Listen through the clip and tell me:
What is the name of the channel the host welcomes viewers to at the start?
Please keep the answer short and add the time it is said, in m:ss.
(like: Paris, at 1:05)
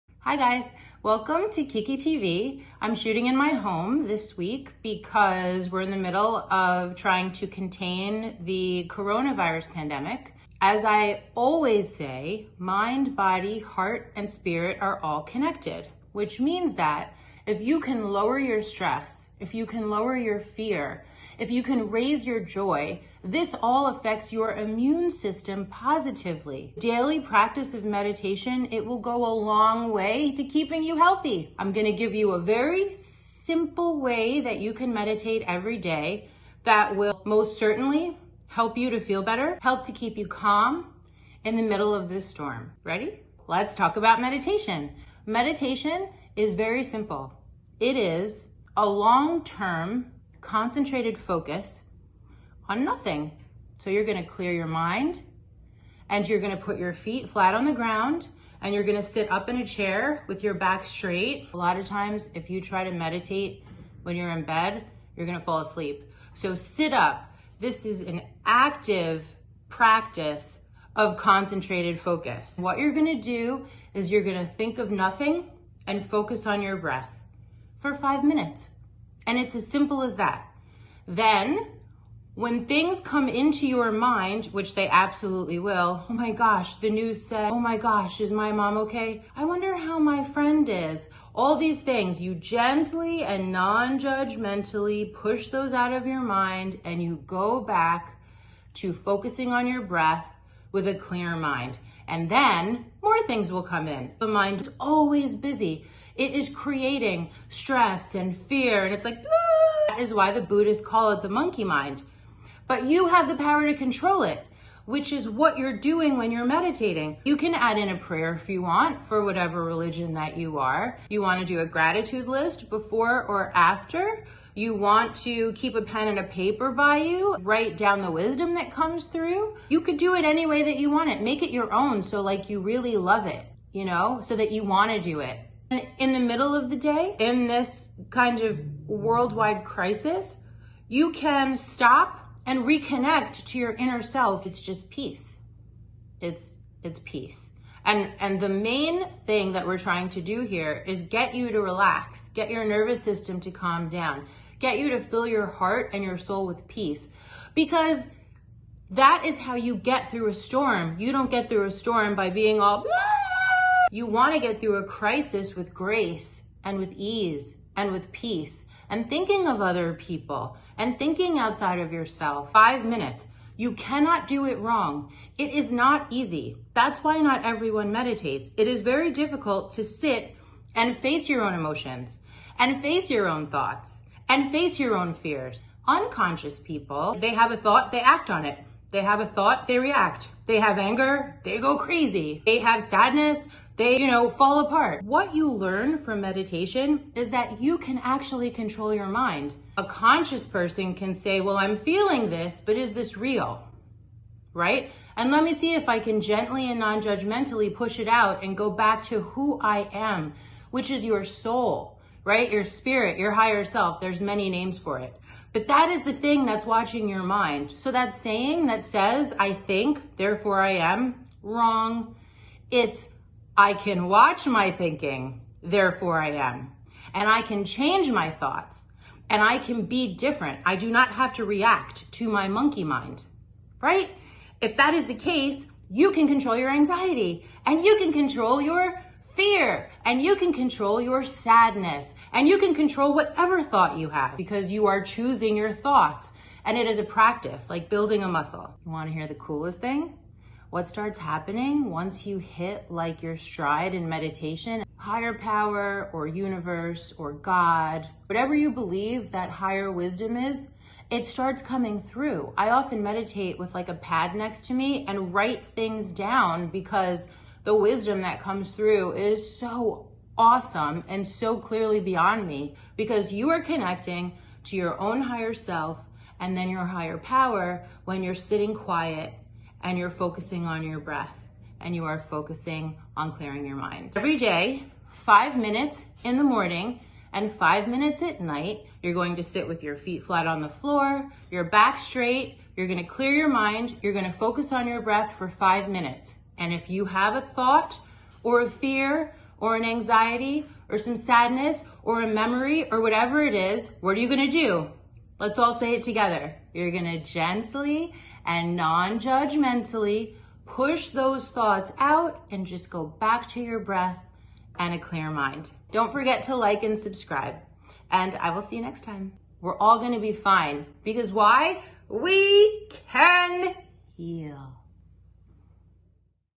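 Kiki TV, at 0:01.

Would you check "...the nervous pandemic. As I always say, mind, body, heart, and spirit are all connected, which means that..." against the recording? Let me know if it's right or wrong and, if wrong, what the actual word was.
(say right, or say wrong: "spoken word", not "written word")
wrong: "coronavirus", not "nervous".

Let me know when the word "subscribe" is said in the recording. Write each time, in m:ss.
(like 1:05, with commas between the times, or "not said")
5:16.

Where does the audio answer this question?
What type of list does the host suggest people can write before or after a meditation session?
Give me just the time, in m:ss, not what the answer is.
2:01.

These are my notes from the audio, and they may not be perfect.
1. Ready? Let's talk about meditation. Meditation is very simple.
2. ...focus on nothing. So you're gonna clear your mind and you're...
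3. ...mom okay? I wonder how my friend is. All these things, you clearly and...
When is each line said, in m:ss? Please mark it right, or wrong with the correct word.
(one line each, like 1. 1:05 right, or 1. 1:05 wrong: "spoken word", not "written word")
1. 0:42 right
2. 0:51 right
3. 1:28 wrong: "gently", not "clearly".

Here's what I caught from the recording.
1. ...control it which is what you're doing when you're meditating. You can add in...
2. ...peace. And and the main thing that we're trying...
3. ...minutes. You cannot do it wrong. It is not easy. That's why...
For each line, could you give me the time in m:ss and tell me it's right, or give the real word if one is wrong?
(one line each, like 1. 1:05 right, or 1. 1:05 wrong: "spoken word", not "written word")
1. 1:53 right
2. 2:27 right
3. 2:52 right.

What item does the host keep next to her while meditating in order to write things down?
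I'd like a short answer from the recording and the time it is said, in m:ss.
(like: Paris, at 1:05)
a pad, at 4:23.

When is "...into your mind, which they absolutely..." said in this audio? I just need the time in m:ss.
1:23.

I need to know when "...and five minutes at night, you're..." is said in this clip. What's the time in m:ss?
4:47.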